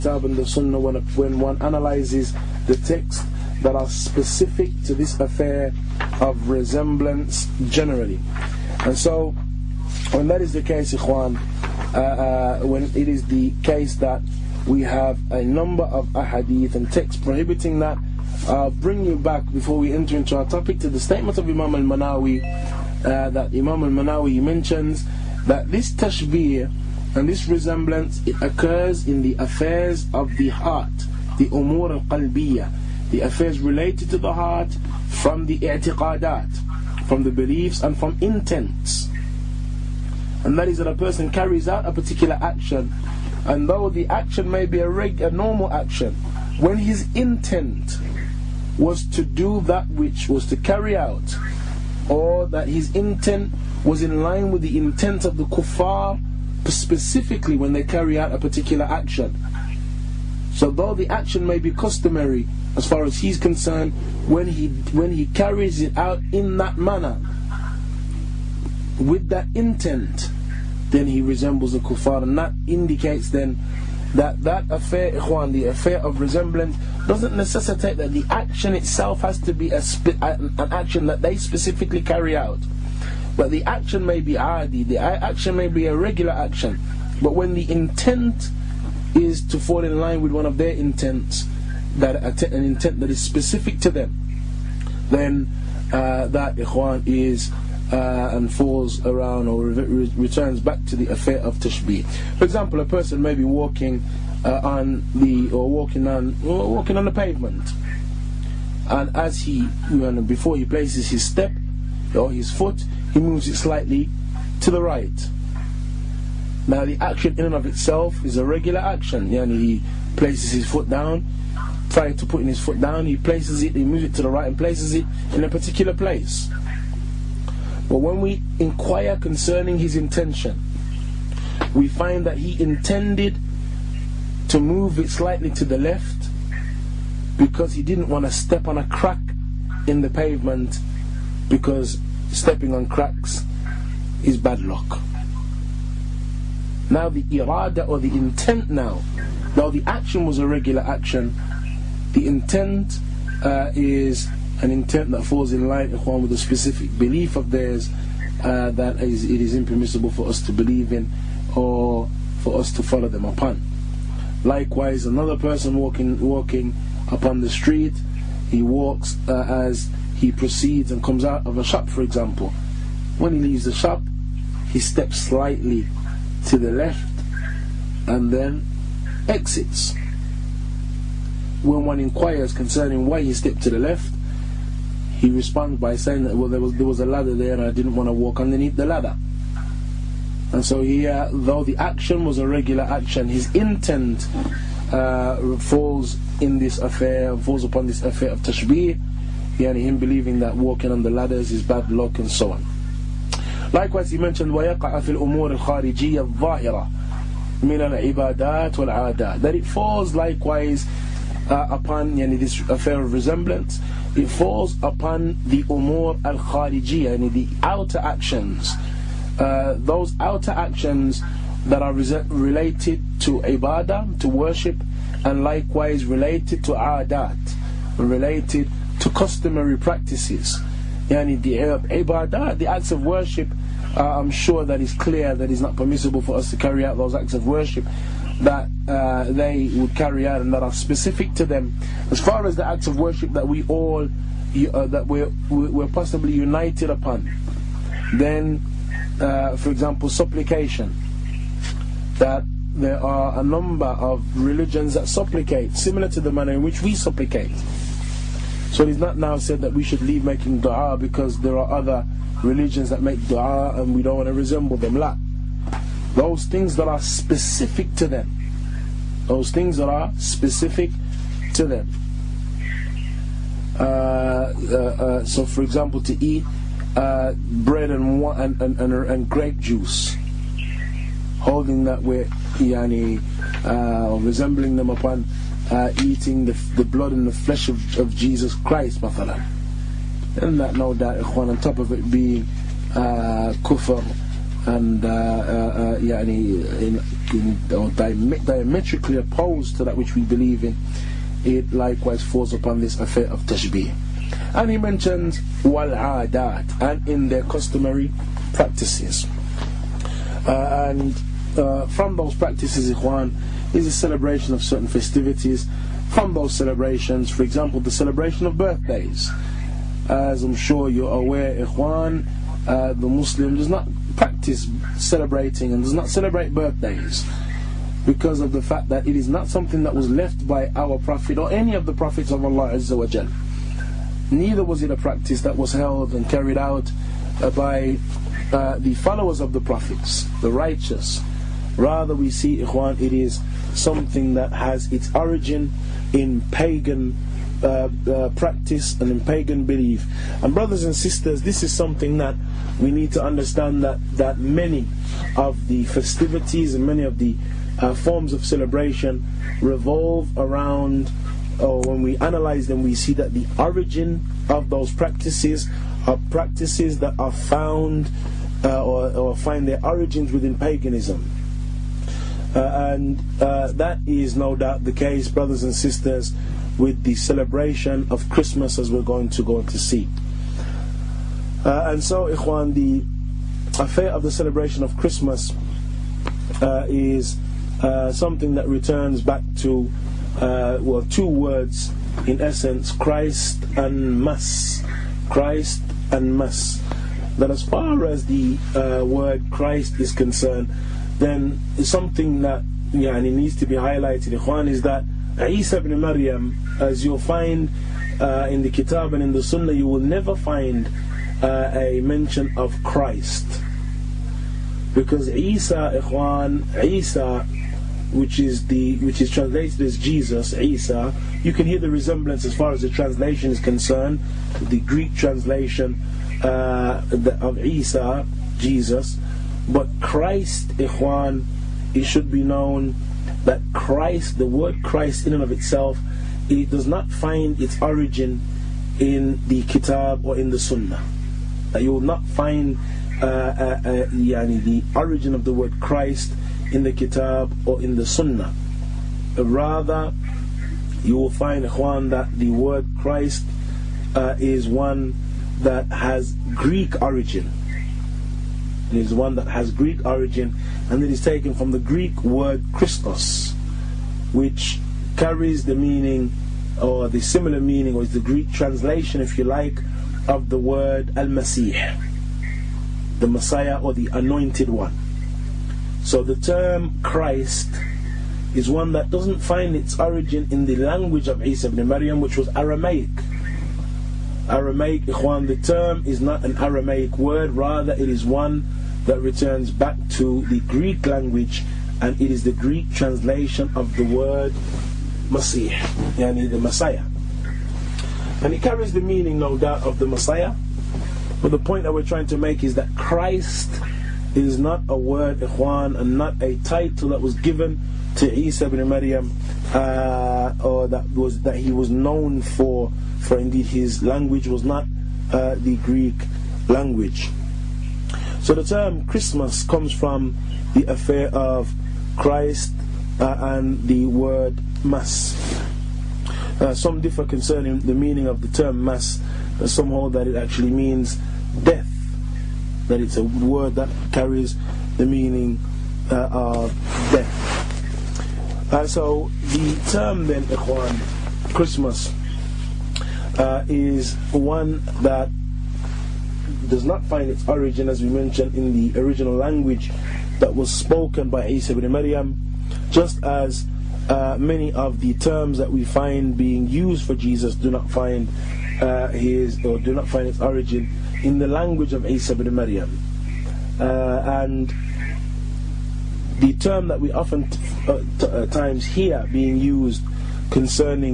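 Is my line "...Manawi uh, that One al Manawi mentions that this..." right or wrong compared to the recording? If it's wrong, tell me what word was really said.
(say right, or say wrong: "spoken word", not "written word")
wrong: "Imam", not "One".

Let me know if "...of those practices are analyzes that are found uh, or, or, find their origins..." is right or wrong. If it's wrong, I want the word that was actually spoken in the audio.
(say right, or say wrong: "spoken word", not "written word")
wrong: "practices", not "analyzes".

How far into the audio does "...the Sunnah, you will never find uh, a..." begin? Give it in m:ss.
6:49.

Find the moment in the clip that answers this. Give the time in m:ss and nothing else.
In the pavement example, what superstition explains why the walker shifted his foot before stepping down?
2:22.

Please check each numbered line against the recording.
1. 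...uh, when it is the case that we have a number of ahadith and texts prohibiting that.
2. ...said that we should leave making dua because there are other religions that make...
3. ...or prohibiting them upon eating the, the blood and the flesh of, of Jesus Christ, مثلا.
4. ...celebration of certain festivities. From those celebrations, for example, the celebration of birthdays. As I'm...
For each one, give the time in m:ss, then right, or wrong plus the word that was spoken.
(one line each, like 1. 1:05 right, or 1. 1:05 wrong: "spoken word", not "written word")
1. 0:11 right
2. 4:19 right
3. 4:44 wrong: "resembling", not "prohibiting"
4. 5:13 right.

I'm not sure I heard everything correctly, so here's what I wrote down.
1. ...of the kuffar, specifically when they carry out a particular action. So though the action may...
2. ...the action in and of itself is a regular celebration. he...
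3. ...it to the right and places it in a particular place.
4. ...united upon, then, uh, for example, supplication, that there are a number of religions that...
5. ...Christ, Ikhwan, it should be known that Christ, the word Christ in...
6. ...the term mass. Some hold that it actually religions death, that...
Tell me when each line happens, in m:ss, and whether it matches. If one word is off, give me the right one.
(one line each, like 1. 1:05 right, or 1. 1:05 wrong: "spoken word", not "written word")
1. 0:55 right
2. 1:56 wrong: "action", not "celebration"
3. 2:04 right
4. 4:06 right
5. 7:10 right
6. 8:48 wrong: "means", not "religions".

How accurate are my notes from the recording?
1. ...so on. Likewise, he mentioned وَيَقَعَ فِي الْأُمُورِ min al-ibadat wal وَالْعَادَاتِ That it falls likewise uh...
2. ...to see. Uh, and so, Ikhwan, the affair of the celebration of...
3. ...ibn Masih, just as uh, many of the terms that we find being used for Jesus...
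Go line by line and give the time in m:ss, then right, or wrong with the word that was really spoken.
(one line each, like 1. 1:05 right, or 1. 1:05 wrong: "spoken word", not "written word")
1. 3:22 right
2. 6:19 right
3. 9:11 wrong: "Maryam", not "Masih".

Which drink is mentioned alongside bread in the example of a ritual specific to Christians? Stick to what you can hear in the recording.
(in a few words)
Grape juice.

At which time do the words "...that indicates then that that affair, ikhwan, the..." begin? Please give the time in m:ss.
1:12.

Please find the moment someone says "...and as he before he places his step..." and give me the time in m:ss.
1:48.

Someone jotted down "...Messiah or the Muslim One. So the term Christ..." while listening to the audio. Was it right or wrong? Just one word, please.
wrong.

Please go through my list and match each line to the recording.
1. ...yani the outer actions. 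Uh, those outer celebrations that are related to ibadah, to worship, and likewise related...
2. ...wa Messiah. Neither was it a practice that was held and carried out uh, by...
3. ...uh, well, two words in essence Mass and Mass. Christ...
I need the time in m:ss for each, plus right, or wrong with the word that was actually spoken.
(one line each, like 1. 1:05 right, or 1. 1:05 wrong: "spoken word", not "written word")
1. 3:37 wrong: "actions", not "celebrations"
2. 5:32 wrong: "Jal", not "Messiah"
3. 6:30 wrong: "Christ", not "Mass".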